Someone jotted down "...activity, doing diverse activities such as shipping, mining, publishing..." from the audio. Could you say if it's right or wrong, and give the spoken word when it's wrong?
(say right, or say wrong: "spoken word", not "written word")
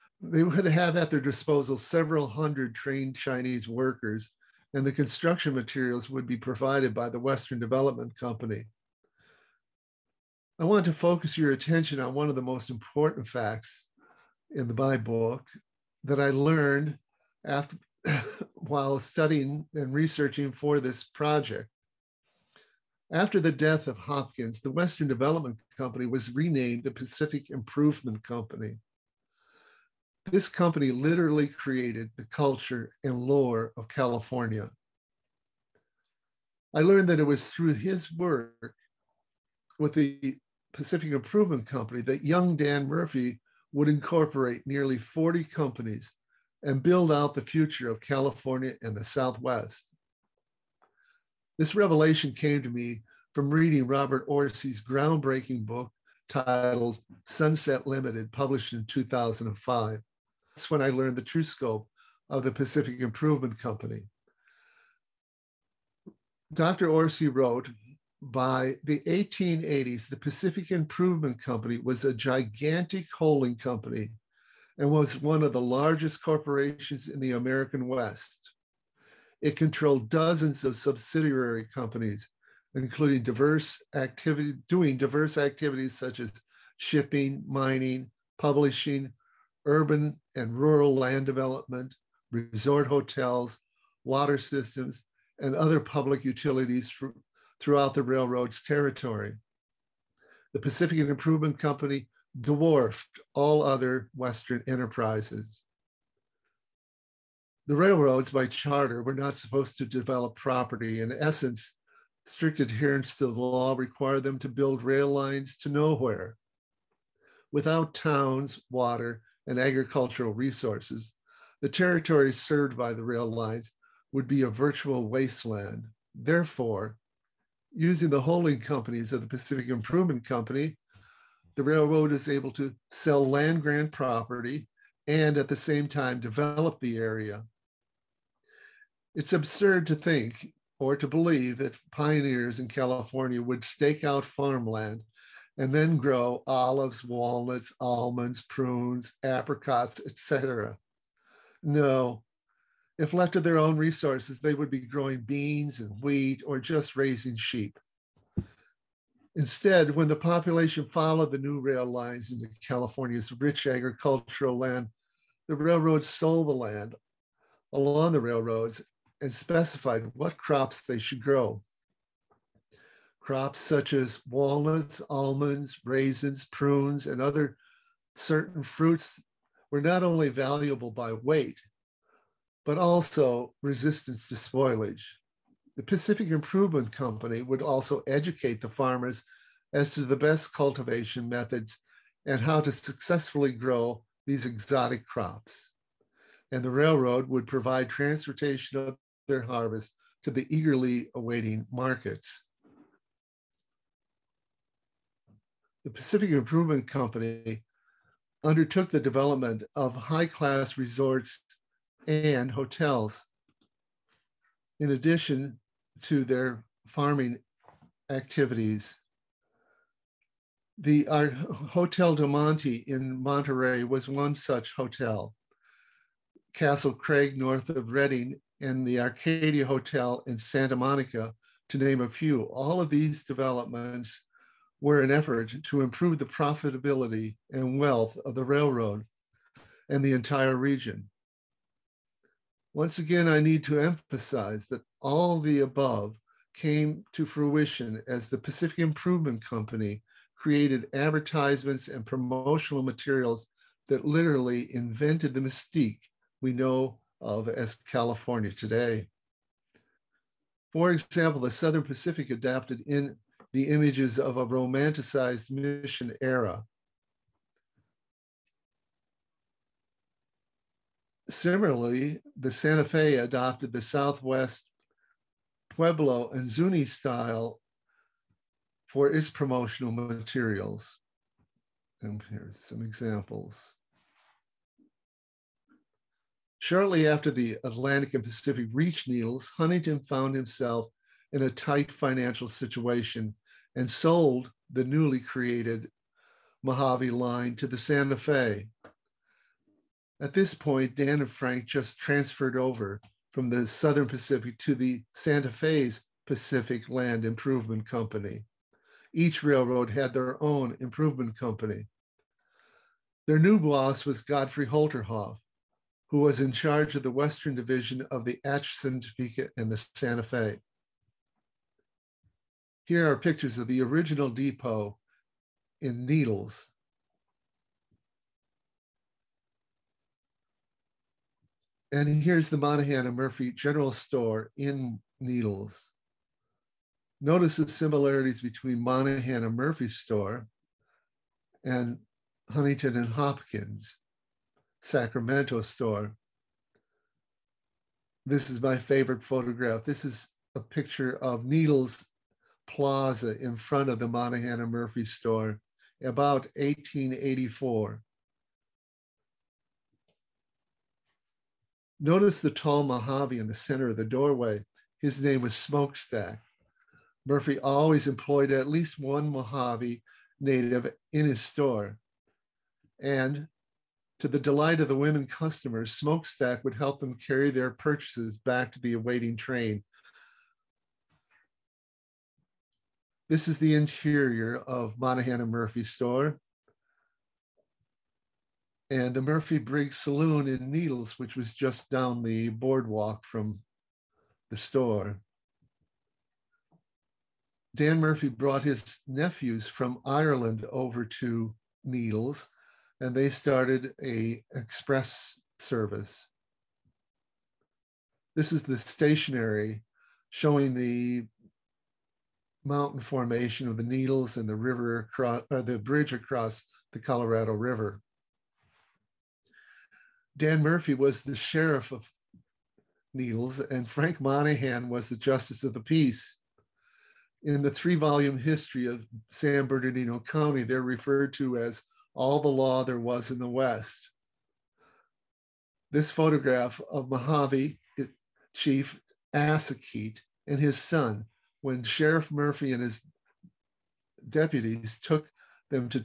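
right.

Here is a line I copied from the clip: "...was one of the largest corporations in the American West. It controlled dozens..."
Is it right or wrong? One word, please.
right.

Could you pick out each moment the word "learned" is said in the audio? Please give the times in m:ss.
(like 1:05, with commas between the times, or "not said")
0:16, 0:36, 1:00.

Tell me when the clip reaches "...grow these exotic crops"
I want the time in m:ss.
3:13.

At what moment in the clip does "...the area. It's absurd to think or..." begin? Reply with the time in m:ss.
2:16.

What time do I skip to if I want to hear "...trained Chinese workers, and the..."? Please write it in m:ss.
0:02.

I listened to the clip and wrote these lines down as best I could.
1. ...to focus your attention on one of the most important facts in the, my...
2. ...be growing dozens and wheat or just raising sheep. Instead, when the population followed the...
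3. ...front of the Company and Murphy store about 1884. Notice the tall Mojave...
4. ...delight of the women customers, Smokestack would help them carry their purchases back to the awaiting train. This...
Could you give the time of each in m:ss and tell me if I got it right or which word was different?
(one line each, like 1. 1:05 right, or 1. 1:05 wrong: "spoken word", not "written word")
1. 0:10 right
2. 2:34 wrong: "beans", not "dozens"
3. 5:53 wrong: "Monahan", not "Company"
4. 6:14 right.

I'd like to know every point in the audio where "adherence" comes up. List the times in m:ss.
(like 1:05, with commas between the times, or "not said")
1:52.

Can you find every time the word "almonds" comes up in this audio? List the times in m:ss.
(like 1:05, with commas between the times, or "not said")
2:27, 2:55.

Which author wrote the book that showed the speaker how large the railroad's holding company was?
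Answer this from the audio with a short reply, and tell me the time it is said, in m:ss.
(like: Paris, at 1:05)
Robert Orsi, at 0:53.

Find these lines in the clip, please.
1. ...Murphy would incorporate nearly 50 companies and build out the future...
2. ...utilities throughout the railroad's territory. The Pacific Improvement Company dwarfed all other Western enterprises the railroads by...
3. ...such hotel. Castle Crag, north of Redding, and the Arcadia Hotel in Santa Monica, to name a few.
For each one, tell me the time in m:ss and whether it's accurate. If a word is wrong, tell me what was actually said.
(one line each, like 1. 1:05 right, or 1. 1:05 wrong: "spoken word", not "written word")
1. 0:42 wrong: "40", not "50"
2. 1:36 right
3. 3:44 right.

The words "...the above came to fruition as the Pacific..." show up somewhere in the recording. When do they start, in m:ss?
4:05.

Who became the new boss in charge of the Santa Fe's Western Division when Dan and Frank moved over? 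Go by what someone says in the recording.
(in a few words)
Godfrey Holterhoff.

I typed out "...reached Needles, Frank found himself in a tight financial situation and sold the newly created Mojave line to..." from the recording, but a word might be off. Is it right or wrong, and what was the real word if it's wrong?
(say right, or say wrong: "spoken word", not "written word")
wrong: "Huntington", not "Frank".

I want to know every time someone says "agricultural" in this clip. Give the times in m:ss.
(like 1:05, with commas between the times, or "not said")
1:59, 2:43.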